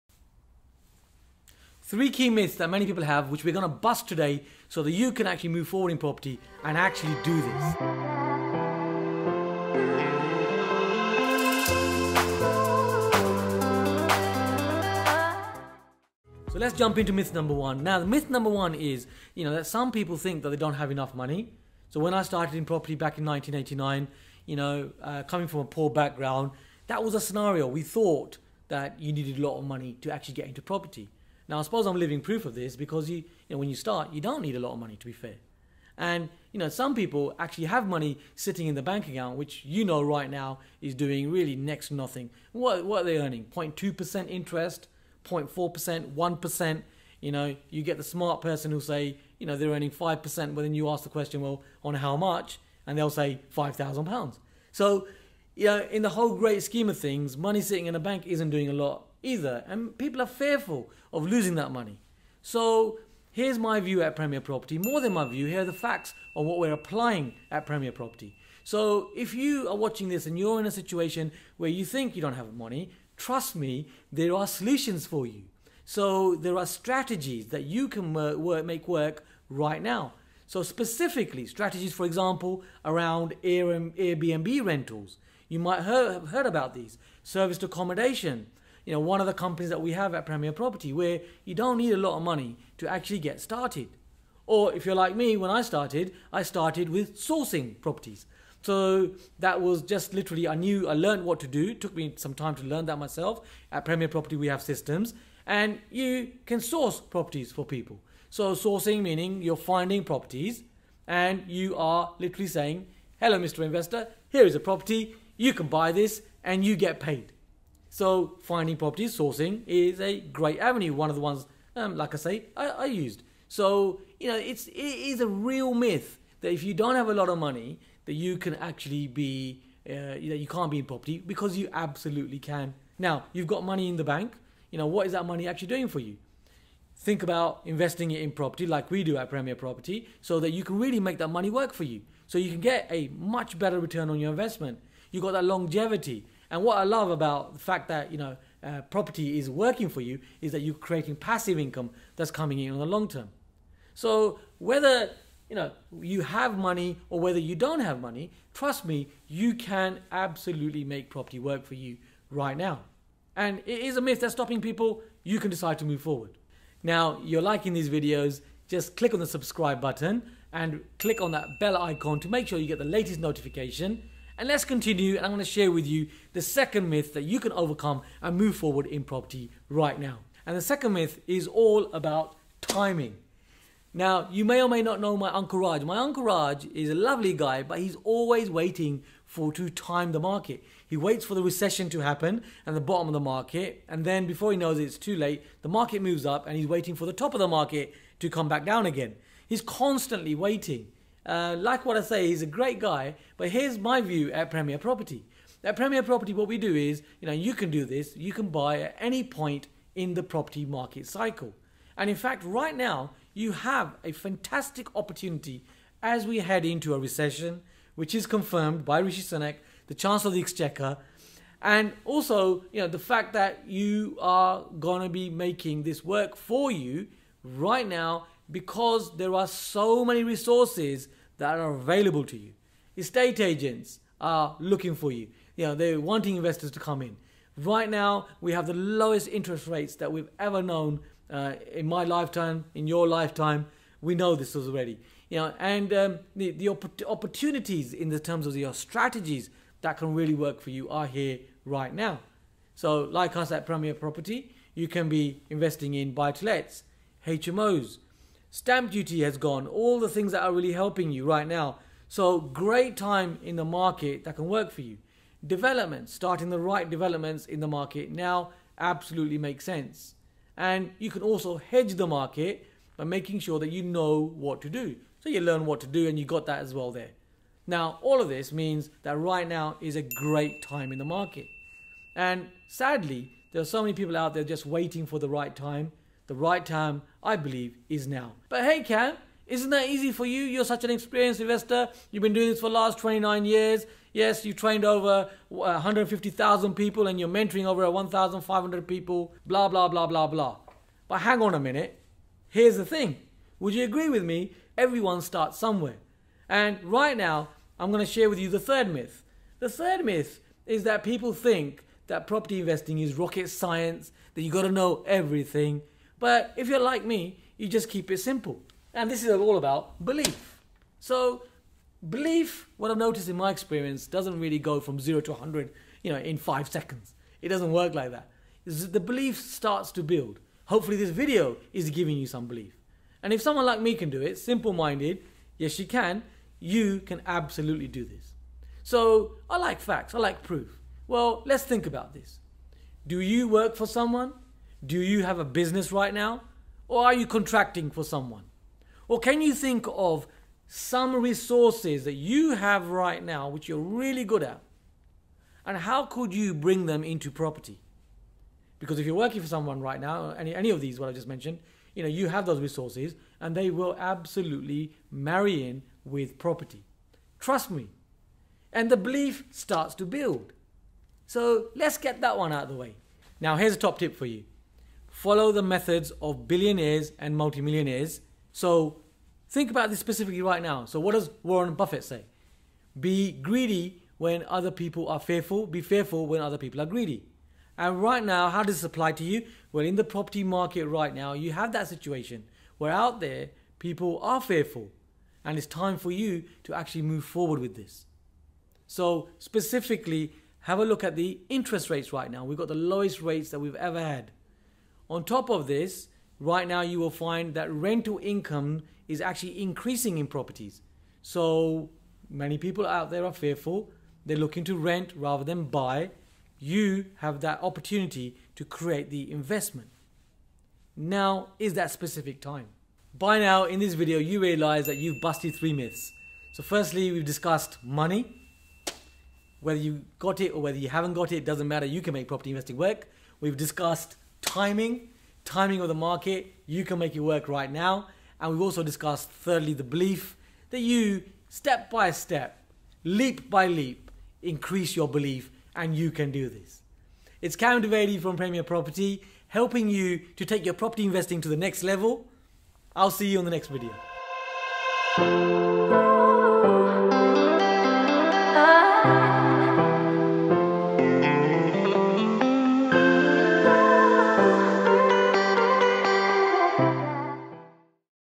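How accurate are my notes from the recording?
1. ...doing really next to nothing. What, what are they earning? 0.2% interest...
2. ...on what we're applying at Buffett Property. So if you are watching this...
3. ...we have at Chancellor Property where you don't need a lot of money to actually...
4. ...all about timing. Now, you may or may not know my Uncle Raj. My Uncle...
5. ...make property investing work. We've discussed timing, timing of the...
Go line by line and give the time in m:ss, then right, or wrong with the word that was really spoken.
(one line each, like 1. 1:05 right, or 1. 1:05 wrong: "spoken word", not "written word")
1. 0:40 right
2. 1:06 wrong: "Premier", not "Buffett"
3. 1:29 wrong: "Premier", not "Chancellor"
4. 3:01 right
5. 7:12 right.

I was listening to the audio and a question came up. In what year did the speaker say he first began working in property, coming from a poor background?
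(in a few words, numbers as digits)
1989.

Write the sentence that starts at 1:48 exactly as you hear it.
So sourcing meaning you're finding properties and you are literally saying, hello, Mr.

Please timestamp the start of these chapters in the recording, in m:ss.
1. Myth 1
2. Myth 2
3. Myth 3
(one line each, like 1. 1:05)
1. 0:16
2. 2:55
3. 5:07.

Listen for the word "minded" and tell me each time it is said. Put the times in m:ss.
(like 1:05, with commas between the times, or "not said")
5:34.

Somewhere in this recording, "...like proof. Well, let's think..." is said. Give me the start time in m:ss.
5:40.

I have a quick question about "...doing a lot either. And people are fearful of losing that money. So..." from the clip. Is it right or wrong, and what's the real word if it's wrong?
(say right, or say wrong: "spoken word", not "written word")
right.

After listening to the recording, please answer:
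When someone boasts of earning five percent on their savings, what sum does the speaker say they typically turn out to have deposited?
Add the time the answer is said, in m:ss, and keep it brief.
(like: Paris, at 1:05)
£5,000, at 0:53.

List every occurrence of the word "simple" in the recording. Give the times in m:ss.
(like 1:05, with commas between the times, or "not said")
5:18, 5:34.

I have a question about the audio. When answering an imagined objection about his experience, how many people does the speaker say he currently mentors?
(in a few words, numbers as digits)
1,500.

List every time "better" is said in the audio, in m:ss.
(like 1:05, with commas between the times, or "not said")
2:23.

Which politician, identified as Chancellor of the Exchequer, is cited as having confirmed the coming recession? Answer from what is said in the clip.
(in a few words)
Rishi Sunak.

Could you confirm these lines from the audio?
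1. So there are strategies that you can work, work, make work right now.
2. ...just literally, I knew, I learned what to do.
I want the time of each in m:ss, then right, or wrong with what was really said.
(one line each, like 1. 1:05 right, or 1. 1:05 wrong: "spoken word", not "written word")
1. 1:15 right
2. 1:39 right.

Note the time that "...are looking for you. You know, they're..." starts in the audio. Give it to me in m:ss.
3:54.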